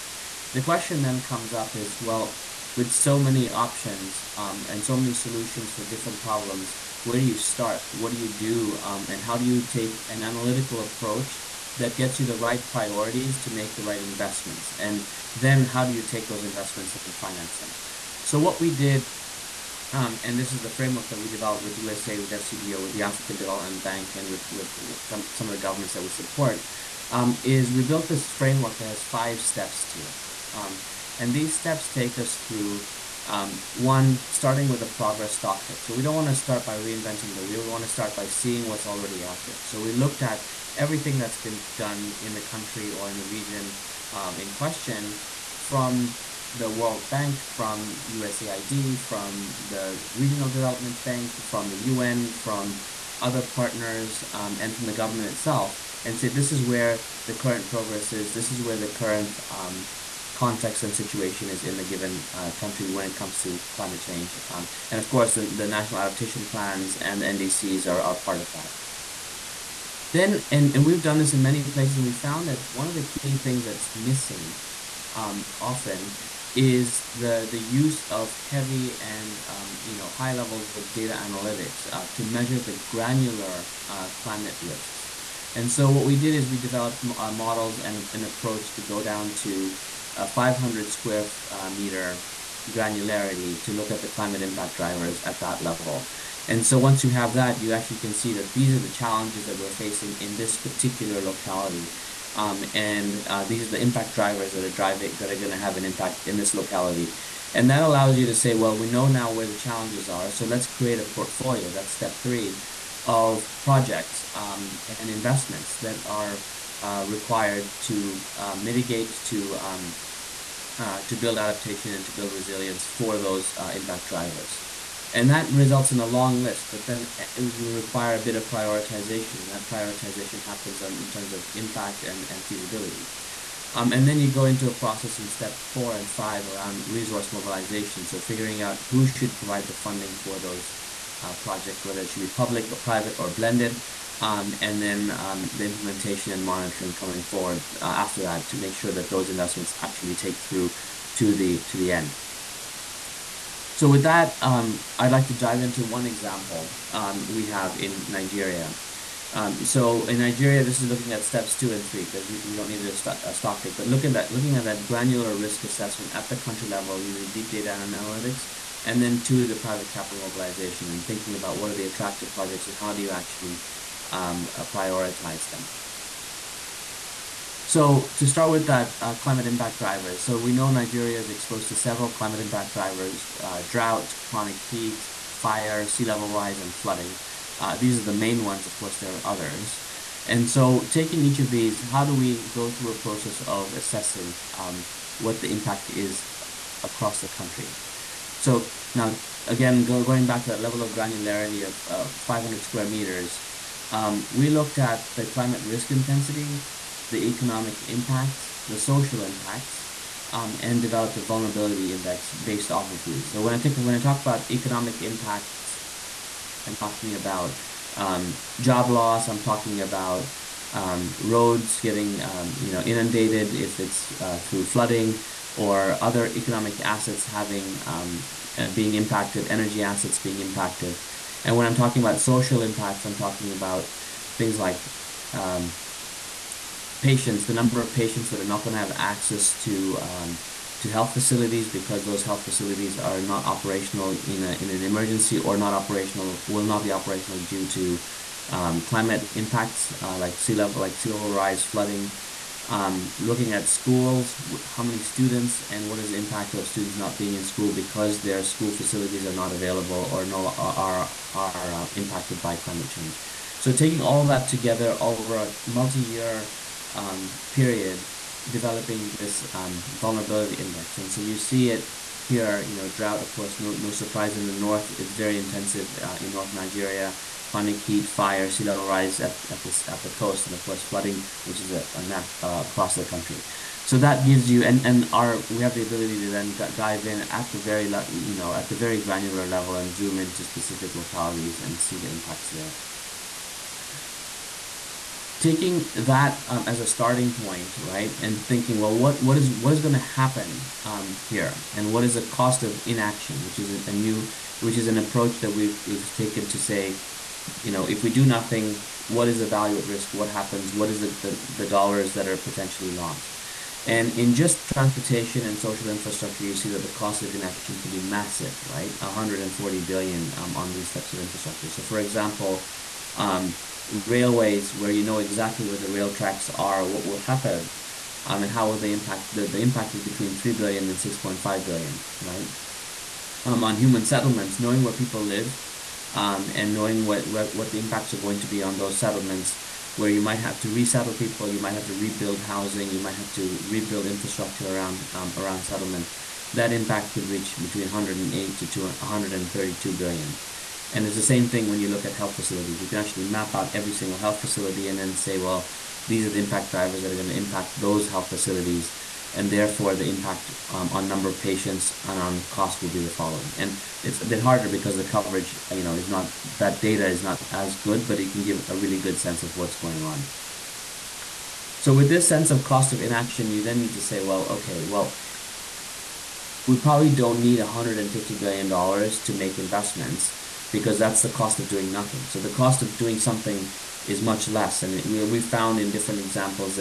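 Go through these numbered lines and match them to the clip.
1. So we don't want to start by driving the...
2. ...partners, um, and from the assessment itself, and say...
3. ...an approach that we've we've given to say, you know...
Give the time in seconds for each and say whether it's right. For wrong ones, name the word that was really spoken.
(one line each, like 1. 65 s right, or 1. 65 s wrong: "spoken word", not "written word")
1. 35 s wrong: "reinventing", not "driving"
2. 53 s wrong: "government", not "assessment"
3. 304 s wrong: "taken", not "given".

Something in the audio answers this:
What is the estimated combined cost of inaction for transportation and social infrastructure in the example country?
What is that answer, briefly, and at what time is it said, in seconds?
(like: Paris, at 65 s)
140 billion, at 318 s.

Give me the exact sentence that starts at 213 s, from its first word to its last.
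So when I think when I talk about economic impacts, I'm talking about um, job loss.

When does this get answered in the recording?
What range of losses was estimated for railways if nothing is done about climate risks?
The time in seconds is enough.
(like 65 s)
329 s.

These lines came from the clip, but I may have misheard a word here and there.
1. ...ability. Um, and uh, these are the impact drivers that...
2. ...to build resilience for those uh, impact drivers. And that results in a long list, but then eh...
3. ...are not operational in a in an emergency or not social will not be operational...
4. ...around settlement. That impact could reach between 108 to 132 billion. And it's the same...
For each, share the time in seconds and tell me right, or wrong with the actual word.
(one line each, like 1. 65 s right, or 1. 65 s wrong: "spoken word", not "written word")
1. 101 s wrong: "locality", not "ability"
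2. 122 s right
3. 242 s wrong: "operational", not "social"
4. 345 s right.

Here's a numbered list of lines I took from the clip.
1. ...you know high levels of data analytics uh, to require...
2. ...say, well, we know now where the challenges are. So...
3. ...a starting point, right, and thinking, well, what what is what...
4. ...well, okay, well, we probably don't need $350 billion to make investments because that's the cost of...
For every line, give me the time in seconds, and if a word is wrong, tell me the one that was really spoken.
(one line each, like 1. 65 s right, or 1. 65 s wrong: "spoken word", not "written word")
1. 79 s wrong: "measure", not "require"
2. 108 s right
3. 296 s right
4. 374 s wrong: "150", not "350".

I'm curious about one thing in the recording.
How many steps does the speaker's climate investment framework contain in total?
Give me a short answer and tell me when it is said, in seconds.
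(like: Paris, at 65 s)
5, at 29 s.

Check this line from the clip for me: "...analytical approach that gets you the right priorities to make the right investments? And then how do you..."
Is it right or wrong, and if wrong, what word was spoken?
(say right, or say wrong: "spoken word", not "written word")
right.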